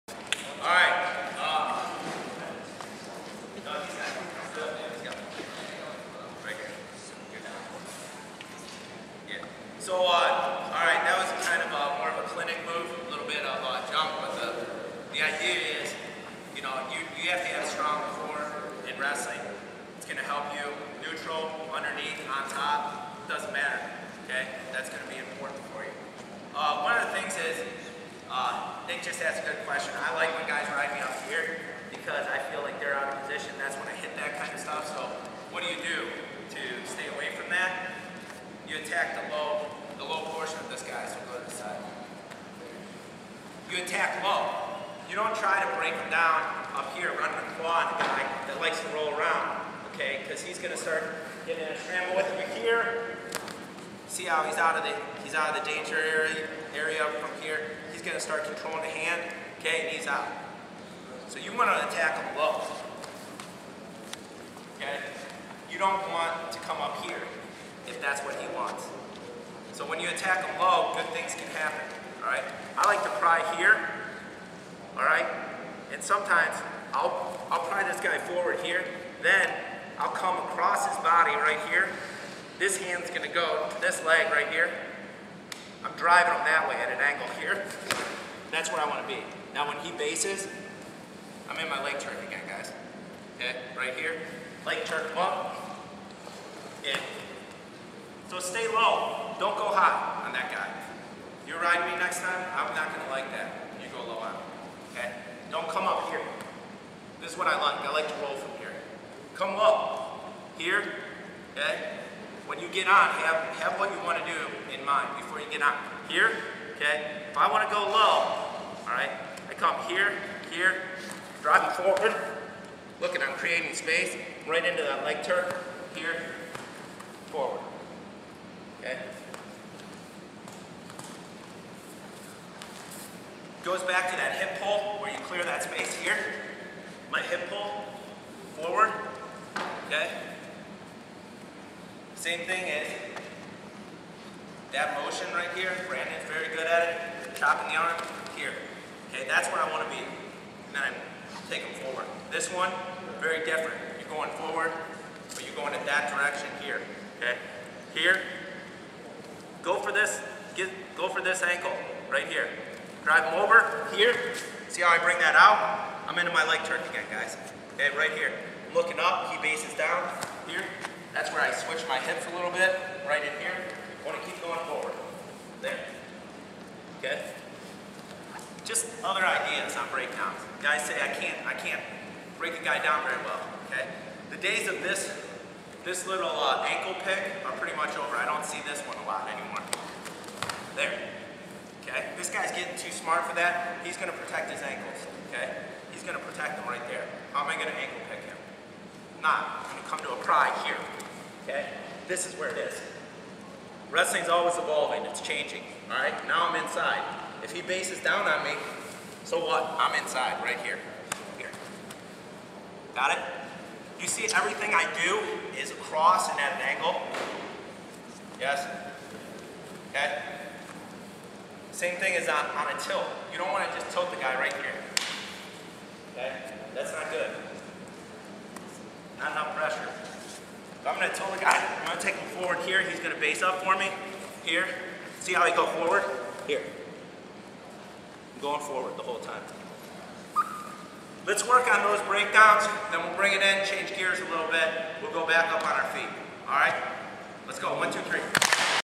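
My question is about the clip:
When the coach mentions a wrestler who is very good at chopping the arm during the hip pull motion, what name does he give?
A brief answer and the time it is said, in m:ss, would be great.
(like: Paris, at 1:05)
Brandon, at 2:25.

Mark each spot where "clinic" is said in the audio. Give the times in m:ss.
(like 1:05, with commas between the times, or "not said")
0:12.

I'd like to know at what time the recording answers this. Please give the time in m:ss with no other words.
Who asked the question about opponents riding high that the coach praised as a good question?
0:28.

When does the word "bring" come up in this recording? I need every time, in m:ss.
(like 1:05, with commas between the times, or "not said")
2:44, 4:03.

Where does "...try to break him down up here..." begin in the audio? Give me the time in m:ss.
0:45.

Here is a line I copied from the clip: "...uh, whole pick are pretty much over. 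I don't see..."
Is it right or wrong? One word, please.
wrong.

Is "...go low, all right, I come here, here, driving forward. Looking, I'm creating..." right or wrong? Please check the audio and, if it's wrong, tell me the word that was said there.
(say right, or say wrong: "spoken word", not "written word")
right.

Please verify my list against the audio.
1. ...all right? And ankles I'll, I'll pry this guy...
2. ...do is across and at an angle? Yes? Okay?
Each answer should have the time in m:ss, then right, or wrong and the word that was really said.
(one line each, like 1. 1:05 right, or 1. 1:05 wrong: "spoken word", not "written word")
1. 1:14 wrong: "sometimes", not "ankles"
2. 3:35 right.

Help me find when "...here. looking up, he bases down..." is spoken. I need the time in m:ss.
2:48.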